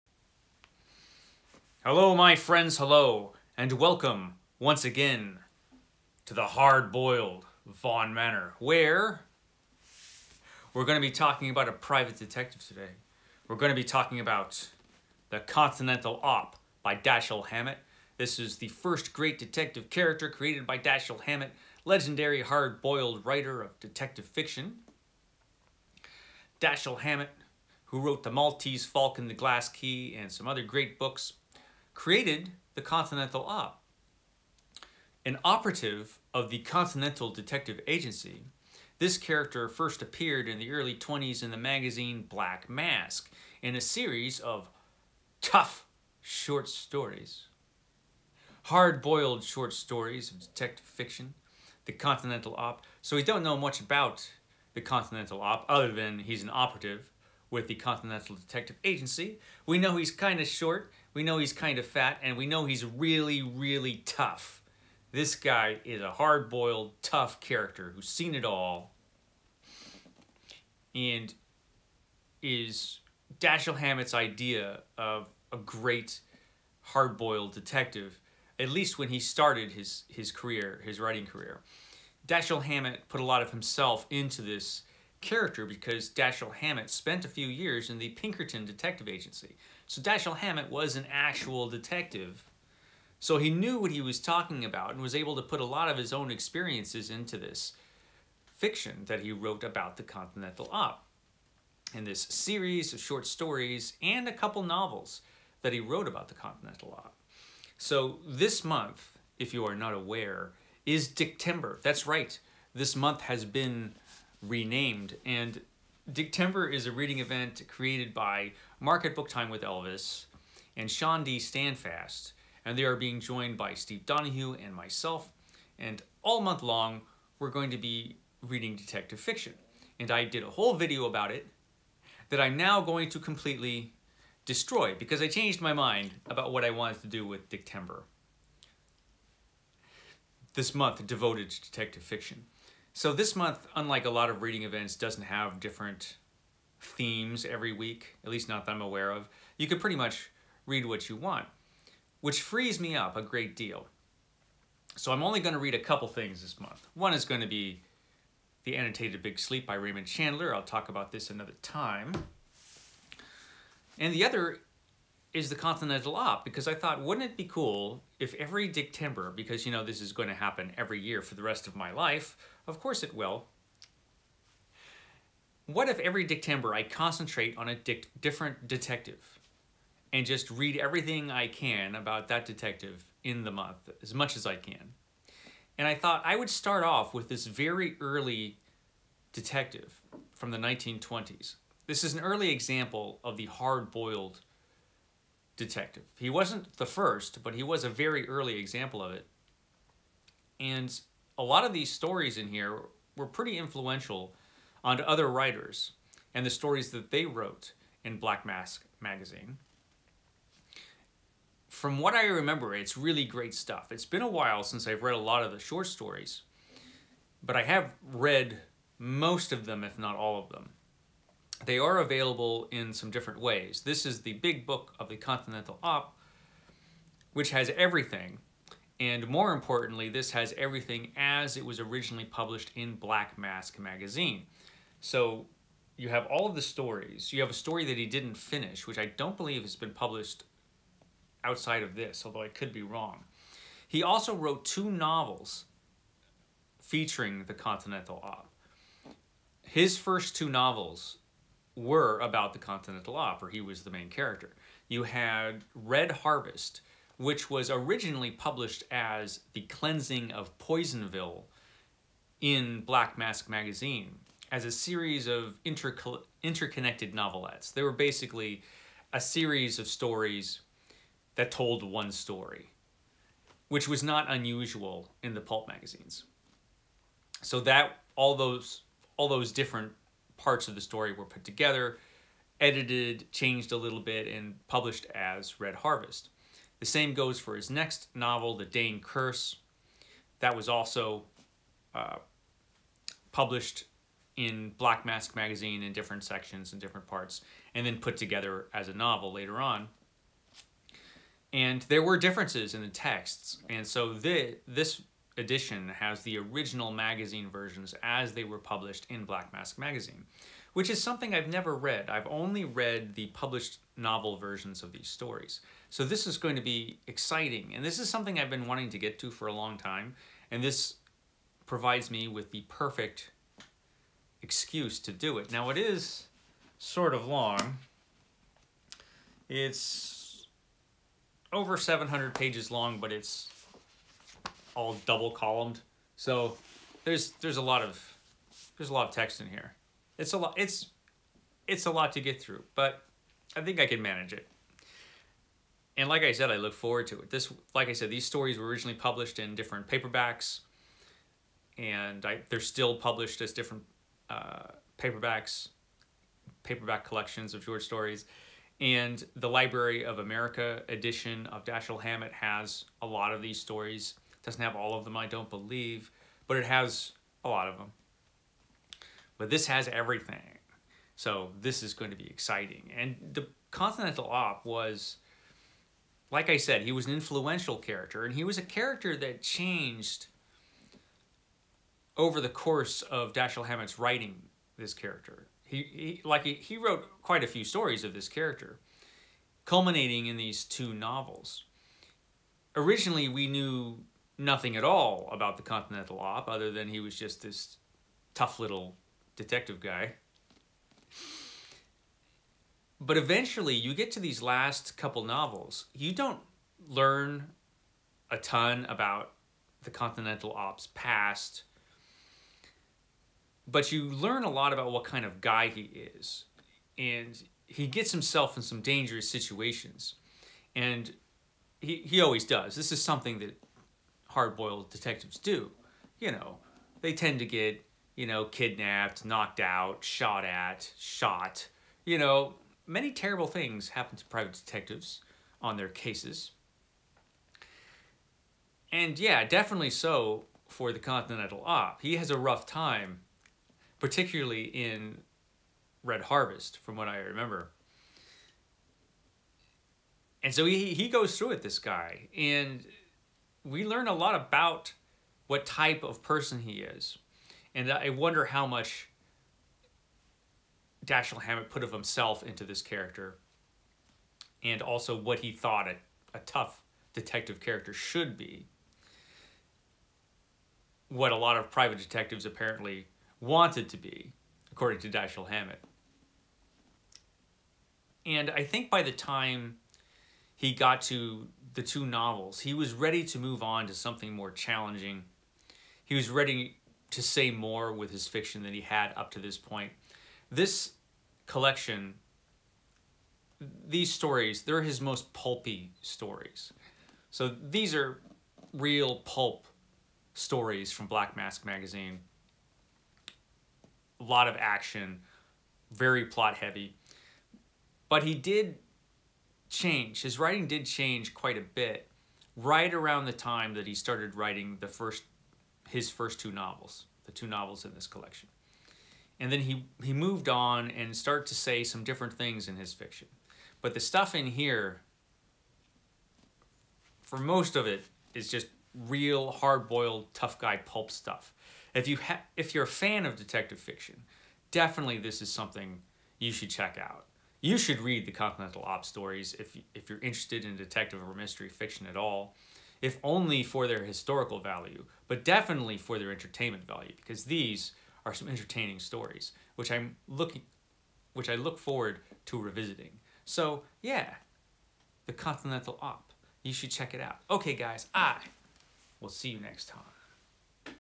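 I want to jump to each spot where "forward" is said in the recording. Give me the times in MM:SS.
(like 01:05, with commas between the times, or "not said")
05:46, 09:11.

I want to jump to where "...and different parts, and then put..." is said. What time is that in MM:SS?
04:56.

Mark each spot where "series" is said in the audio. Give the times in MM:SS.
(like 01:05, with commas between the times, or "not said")
00:43, 01:42, 04:24, 04:29.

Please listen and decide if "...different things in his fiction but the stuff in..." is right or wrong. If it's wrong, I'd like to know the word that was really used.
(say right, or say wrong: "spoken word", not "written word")
right.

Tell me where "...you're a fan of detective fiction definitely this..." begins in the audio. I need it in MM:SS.
08:52.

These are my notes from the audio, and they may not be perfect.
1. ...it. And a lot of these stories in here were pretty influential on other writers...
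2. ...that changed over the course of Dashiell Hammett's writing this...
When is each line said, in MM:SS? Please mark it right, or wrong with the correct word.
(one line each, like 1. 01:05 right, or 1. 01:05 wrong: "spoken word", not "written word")
1. 03:19 right
2. 06:19 right.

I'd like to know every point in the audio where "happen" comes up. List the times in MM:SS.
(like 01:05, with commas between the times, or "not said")
02:50, 07:13.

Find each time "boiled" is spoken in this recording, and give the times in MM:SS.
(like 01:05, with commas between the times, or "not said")
00:06, 00:22, 00:48, 01:06, 01:16, 03:13, 07:04, 08:49.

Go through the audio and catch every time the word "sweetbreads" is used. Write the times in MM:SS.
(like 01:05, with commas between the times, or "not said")
not said.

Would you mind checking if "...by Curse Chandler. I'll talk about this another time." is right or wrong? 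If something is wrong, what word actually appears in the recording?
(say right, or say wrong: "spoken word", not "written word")
wrong: "Raymond", not "Curse".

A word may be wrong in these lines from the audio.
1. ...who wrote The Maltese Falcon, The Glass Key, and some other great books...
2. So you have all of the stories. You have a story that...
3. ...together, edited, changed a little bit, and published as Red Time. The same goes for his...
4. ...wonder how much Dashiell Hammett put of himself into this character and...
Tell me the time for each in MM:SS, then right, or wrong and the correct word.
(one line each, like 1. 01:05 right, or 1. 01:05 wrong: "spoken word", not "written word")
1. 00:27 right
2. 03:54 right
3. 04:41 wrong: "Harvest", not "Time"
4. 07:38 right.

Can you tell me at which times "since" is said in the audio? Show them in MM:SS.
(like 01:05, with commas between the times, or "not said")
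03:34.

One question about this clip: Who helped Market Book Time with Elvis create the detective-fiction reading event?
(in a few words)
Shawn D. Standfast.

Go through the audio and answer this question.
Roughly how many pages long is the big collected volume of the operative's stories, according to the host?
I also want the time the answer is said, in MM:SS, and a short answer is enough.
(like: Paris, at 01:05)
over 700, at 05:31.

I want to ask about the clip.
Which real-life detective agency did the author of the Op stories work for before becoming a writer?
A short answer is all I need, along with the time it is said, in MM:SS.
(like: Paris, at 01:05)
Pinkerton Detective Agency, at 01:28.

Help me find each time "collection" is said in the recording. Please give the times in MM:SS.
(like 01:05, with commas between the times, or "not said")
05:57, 08:11, 08:38.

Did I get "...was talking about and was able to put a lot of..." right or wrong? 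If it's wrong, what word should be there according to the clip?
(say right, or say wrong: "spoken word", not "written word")
right.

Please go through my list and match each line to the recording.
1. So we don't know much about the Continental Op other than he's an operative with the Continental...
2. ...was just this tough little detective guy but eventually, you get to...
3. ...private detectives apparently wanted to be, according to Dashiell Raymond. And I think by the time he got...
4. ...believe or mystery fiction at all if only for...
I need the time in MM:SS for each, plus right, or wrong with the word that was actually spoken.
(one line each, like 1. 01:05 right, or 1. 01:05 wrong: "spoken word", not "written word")
1. 00:53 right
2. 06:36 right
3. 07:51 wrong: "Hammett", not "Raymond"
4. 09:00 wrong: "detective", not "believe".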